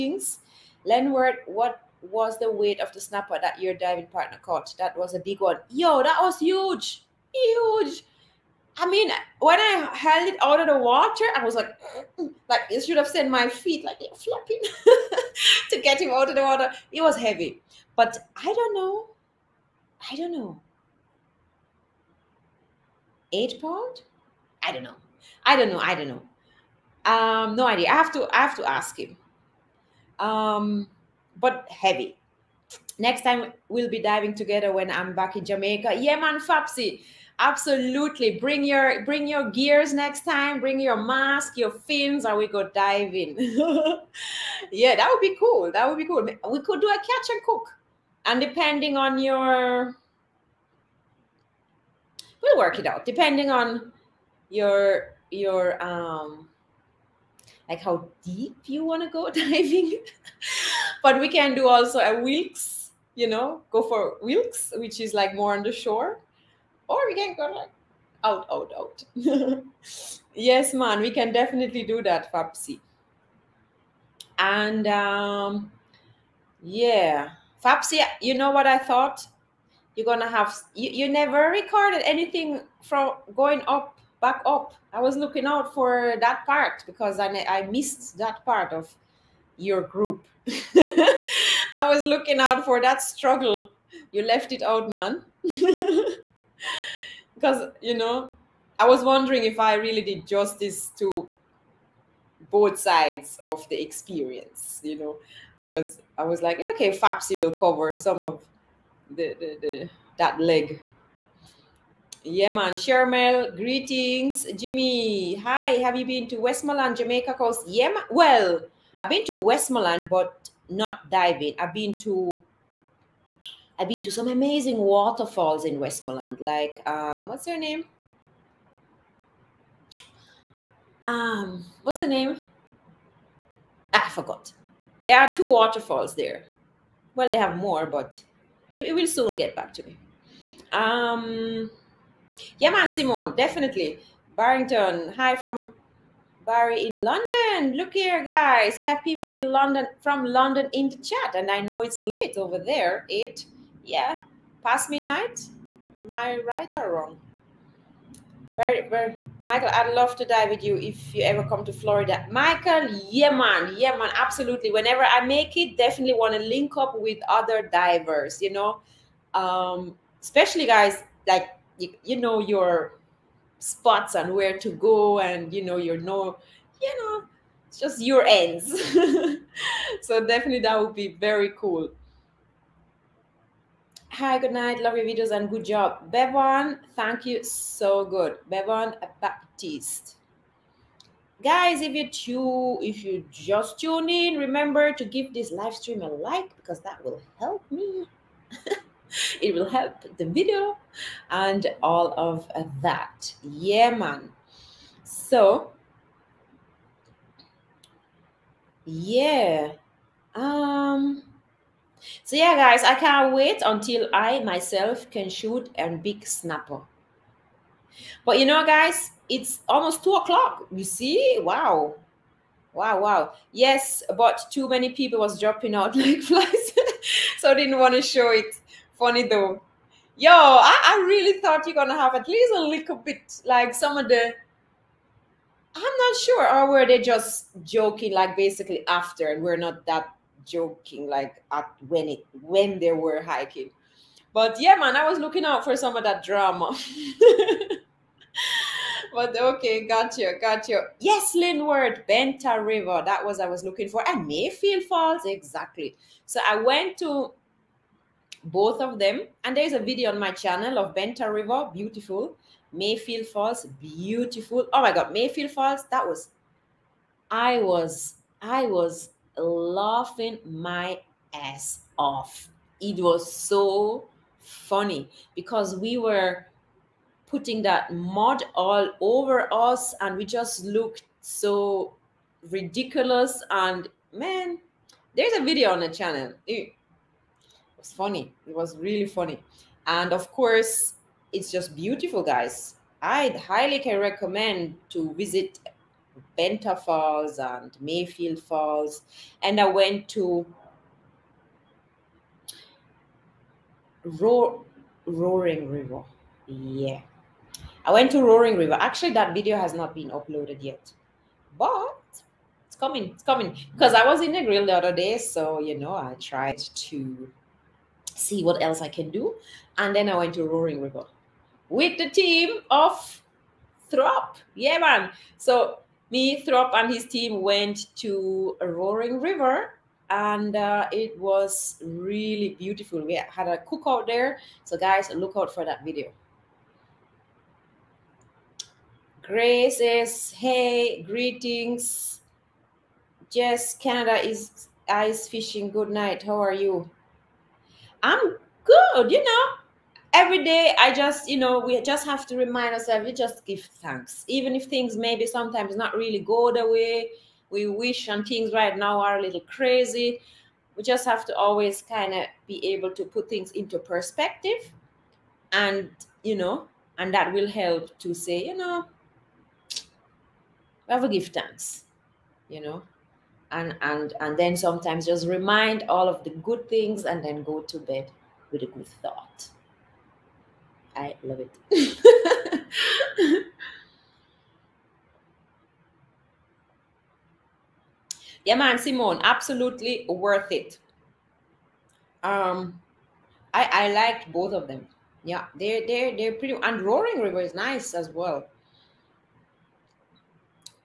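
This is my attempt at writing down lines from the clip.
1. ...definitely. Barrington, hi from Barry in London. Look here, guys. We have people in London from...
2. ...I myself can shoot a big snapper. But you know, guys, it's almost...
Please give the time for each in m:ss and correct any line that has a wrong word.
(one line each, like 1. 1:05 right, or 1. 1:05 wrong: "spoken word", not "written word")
1. 2:23 right
2. 3:34 right.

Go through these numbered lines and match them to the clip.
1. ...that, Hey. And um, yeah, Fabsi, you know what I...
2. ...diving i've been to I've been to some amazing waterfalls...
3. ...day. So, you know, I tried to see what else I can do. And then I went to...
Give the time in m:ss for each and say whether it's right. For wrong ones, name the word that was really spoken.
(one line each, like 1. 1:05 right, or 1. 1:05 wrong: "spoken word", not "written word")
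1. 1:12 wrong: "Fabsi", not "Hey"
2. 2:01 right
3. 5:14 right.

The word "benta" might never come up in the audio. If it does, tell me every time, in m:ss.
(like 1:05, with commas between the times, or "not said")
4:12, 4:20, 4:56.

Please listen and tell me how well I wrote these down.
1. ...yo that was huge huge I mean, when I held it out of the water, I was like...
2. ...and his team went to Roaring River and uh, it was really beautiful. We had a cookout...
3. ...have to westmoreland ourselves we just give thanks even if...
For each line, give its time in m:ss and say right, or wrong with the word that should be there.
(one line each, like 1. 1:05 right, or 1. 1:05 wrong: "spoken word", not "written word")
1. 0:05 right
2. 5:26 right
3. 5:52 wrong: "remind", not "westmoreland".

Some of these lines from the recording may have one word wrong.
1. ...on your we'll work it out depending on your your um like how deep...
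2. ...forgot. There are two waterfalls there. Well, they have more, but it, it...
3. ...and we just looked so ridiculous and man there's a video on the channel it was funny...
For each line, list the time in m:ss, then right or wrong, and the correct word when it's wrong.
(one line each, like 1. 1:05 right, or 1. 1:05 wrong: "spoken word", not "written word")
1. 0:48 right
2. 2:14 right
3. 4:40 right.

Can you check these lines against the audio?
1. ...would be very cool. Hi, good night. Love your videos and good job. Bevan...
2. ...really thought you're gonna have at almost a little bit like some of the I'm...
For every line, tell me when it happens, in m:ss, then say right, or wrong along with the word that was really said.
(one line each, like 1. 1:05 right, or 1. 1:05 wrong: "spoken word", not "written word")
1. 3:00 right
2. 3:51 wrong: "least", not "almost".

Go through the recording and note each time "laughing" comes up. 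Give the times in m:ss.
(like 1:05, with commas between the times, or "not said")
4:29.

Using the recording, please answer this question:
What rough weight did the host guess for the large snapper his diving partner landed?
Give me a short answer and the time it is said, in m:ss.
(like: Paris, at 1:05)
8 pounds, at 0:23.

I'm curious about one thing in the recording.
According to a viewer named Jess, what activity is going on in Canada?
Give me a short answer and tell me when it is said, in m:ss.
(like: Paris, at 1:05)
Ice fishing, at 5:44.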